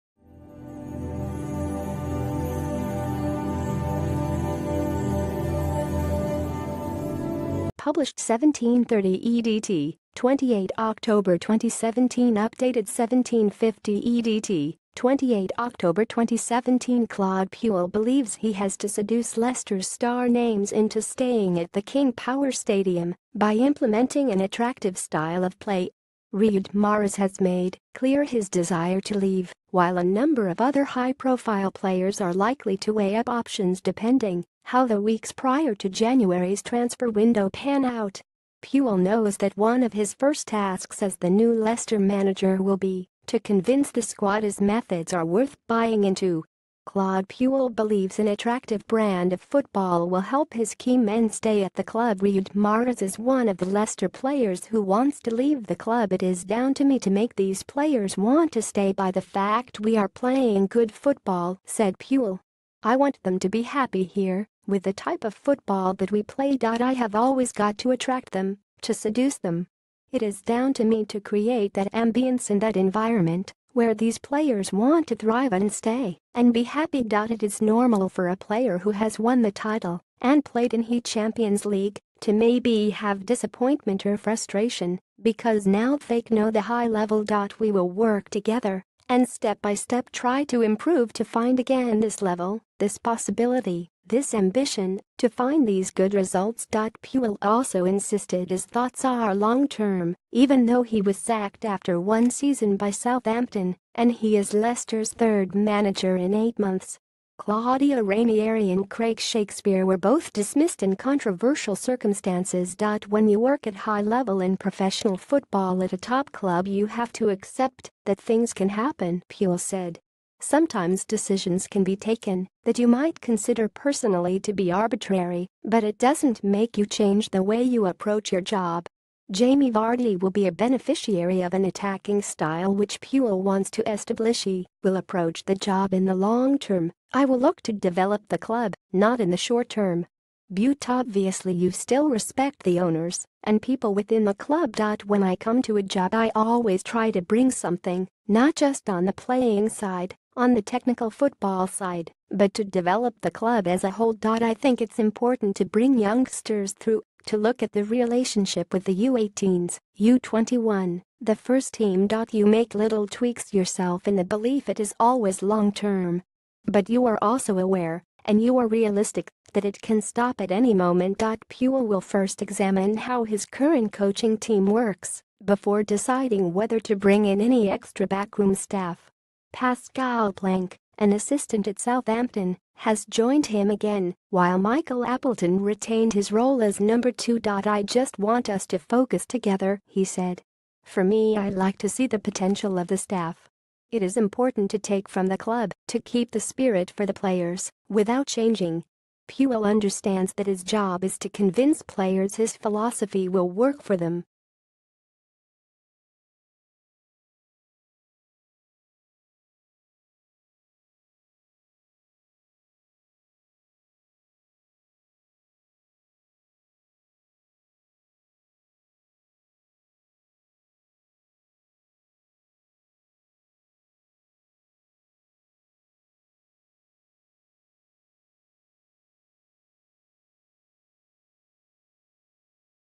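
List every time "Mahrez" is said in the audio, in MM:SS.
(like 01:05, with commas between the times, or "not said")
00:26, 00:52.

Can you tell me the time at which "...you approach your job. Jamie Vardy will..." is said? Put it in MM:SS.
02:07.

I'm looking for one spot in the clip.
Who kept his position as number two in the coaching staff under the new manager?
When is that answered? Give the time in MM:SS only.
03:04.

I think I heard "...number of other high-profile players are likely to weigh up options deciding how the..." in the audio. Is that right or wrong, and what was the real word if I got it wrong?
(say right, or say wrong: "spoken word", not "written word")
wrong: "depending", not "deciding".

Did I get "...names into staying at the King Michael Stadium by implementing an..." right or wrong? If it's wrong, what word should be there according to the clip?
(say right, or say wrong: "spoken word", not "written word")
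wrong: "Power", not "Michael".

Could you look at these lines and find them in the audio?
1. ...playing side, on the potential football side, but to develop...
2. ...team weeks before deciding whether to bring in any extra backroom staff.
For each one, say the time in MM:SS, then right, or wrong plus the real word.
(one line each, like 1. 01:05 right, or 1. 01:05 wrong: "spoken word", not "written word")
1. 02:29 wrong: "technical", not "potential"
2. 02:54 wrong: "works", not "weeks".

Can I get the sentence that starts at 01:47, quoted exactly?
Claudio Ranieri and Craig Shakespeare were both dismissed in controversial circumstances.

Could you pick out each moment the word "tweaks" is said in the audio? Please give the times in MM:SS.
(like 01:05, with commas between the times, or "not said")
02:43.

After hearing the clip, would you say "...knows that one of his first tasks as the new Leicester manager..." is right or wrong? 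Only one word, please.
right.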